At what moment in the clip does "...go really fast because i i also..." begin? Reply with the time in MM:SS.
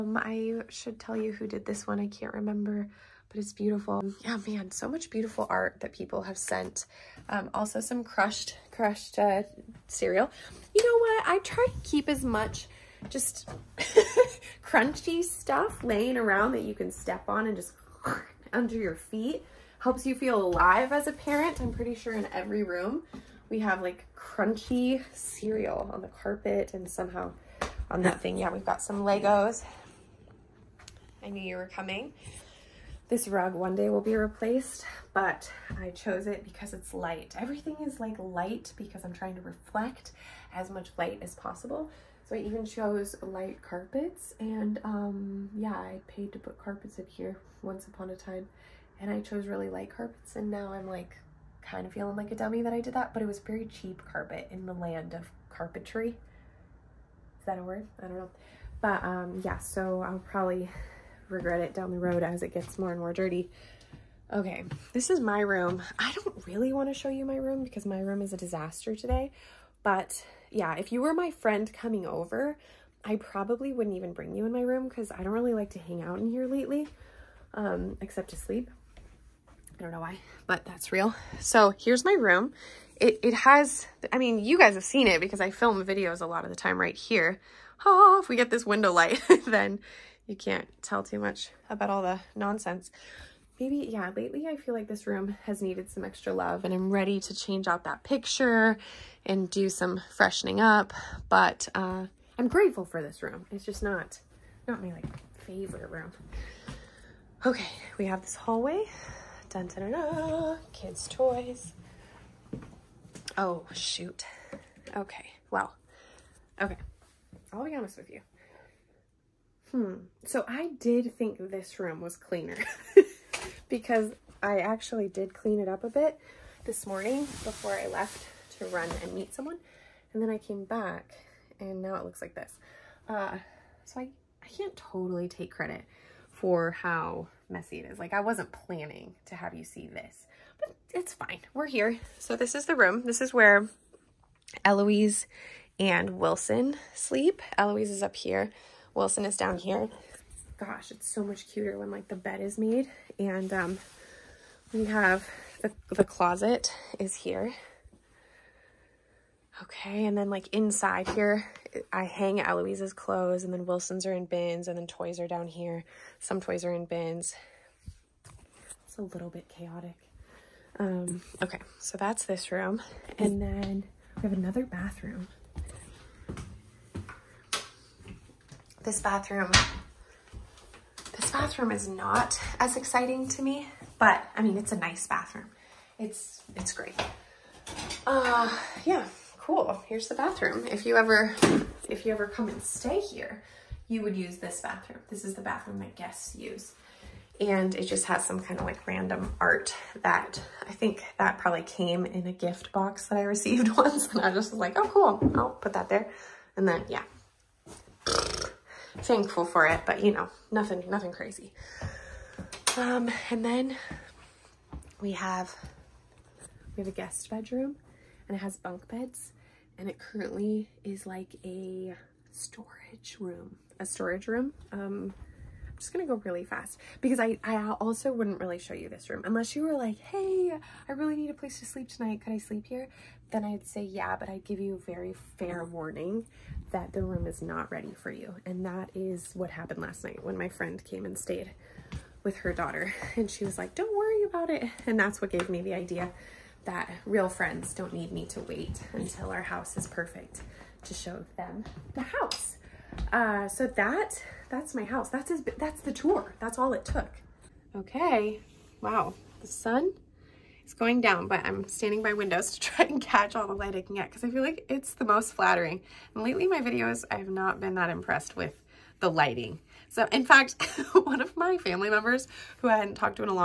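03:46.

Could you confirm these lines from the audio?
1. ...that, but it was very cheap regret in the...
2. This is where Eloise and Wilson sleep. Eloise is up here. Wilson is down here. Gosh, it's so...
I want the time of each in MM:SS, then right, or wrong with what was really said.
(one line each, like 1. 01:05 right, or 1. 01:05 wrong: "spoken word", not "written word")
1. 00:52 wrong: "carpet", not "regret"
2. 02:23 right.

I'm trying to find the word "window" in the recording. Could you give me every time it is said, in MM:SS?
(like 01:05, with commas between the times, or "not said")
01:28, 04:22.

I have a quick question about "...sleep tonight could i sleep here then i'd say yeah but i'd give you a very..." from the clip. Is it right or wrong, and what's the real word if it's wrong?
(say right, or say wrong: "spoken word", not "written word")
right.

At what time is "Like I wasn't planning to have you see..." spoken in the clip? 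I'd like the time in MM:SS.
02:17.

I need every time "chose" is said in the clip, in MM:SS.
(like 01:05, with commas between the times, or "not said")
00:35, 00:42, 00:49.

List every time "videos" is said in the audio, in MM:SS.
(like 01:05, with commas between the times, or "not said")
01:25, 04:26.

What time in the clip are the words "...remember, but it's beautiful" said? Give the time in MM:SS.
00:02.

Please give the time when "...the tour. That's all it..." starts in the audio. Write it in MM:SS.
04:15.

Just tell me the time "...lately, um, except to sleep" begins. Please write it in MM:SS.
01:16.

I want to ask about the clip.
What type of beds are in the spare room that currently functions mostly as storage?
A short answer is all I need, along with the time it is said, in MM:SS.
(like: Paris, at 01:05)
Bunk beds, at 03:38.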